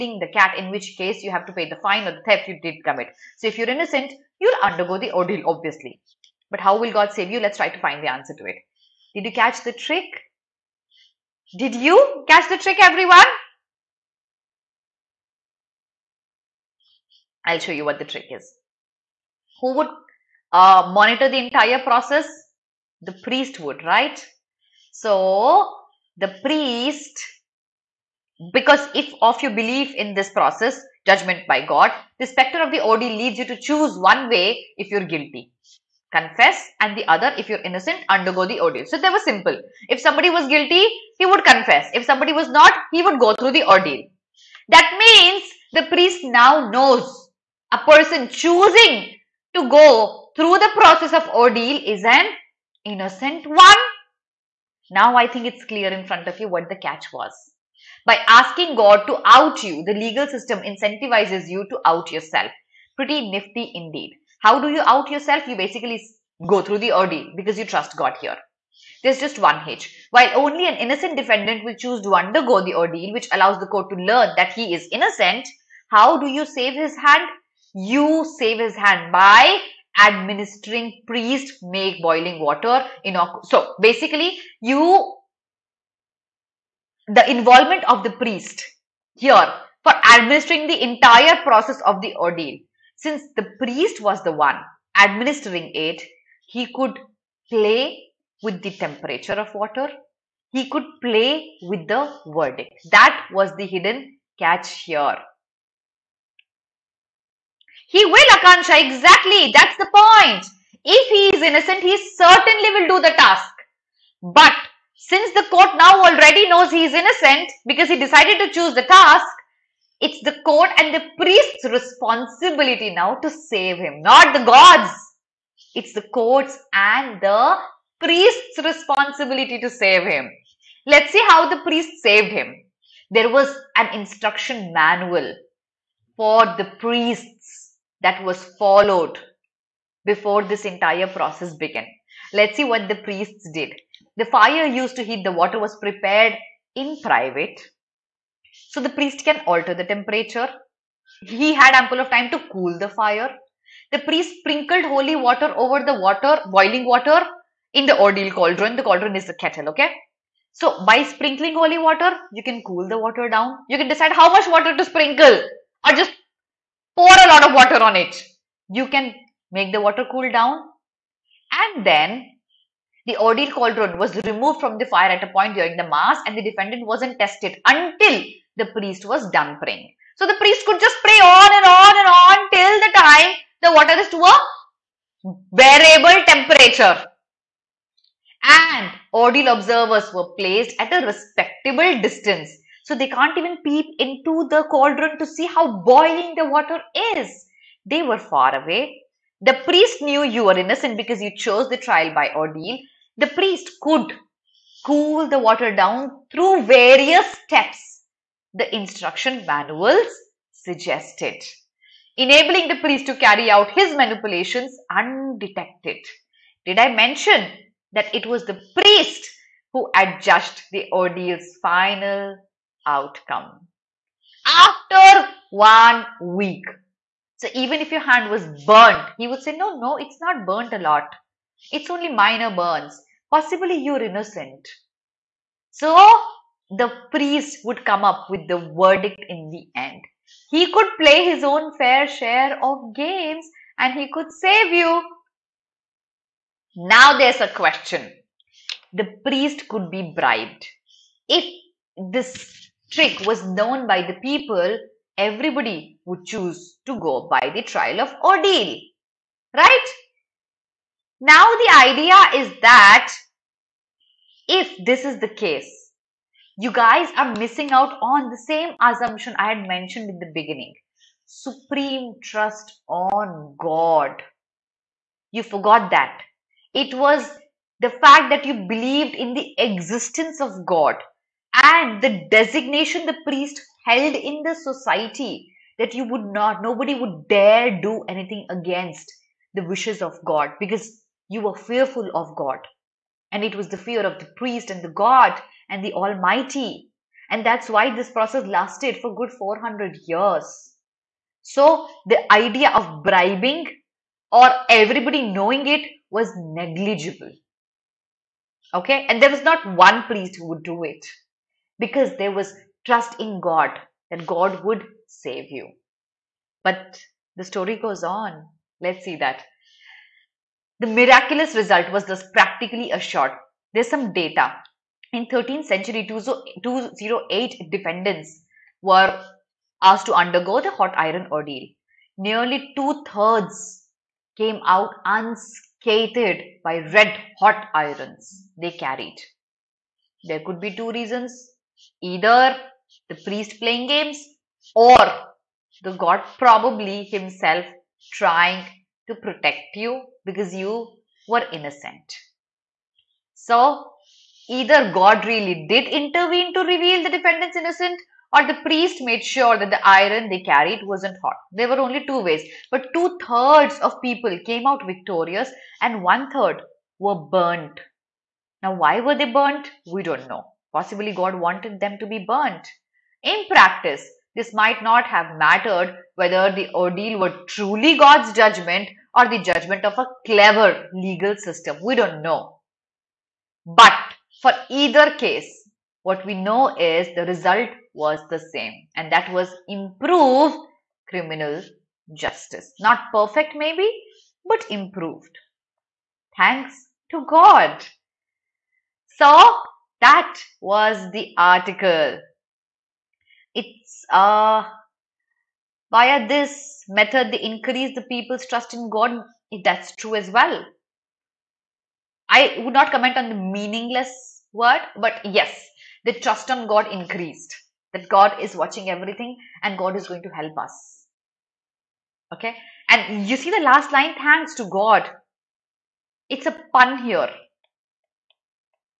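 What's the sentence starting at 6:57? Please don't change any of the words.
That God is watching everything and God is going to help us.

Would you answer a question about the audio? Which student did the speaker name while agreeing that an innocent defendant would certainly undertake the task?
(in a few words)
Akansha.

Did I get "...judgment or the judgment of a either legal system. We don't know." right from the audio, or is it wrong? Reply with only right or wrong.
wrong.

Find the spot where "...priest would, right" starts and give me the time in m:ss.
0:23.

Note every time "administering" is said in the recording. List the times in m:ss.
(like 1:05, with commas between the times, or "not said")
1:20, 1:30, 1:34.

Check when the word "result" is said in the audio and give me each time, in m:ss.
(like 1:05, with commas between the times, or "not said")
5:21, 6:27.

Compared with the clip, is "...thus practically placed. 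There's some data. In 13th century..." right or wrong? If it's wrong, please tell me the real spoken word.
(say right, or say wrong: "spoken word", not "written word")
wrong: "assured", not "placed".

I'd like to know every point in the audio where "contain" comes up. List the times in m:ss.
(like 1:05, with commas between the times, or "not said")
not said.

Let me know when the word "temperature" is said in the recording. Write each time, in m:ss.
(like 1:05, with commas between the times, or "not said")
1:38, 2:29, 3:06.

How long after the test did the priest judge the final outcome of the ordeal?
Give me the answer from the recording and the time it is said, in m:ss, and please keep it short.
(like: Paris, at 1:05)
One week, at 3:44.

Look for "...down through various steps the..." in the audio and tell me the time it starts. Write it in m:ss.
3:25.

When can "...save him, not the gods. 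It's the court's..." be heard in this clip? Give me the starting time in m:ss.
2:03.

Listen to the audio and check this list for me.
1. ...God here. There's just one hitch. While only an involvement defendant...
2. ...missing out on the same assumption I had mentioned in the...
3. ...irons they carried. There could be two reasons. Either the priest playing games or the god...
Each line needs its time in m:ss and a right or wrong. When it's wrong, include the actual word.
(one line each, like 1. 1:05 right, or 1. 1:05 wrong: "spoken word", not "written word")
1. 1:07 wrong: "innocent", not "involvement"
2. 4:27 right
3. 5:37 right.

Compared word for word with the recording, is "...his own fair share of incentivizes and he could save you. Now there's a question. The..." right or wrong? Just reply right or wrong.
wrong.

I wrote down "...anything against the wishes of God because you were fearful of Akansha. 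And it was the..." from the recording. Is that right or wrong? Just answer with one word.
wrong.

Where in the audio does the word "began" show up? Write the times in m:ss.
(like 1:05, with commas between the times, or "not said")
2:21.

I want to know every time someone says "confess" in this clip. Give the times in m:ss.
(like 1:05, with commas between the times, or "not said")
0:36, 0:41.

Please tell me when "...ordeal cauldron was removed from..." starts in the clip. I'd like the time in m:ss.
2:53.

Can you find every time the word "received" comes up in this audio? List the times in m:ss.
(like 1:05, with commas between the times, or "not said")
not said.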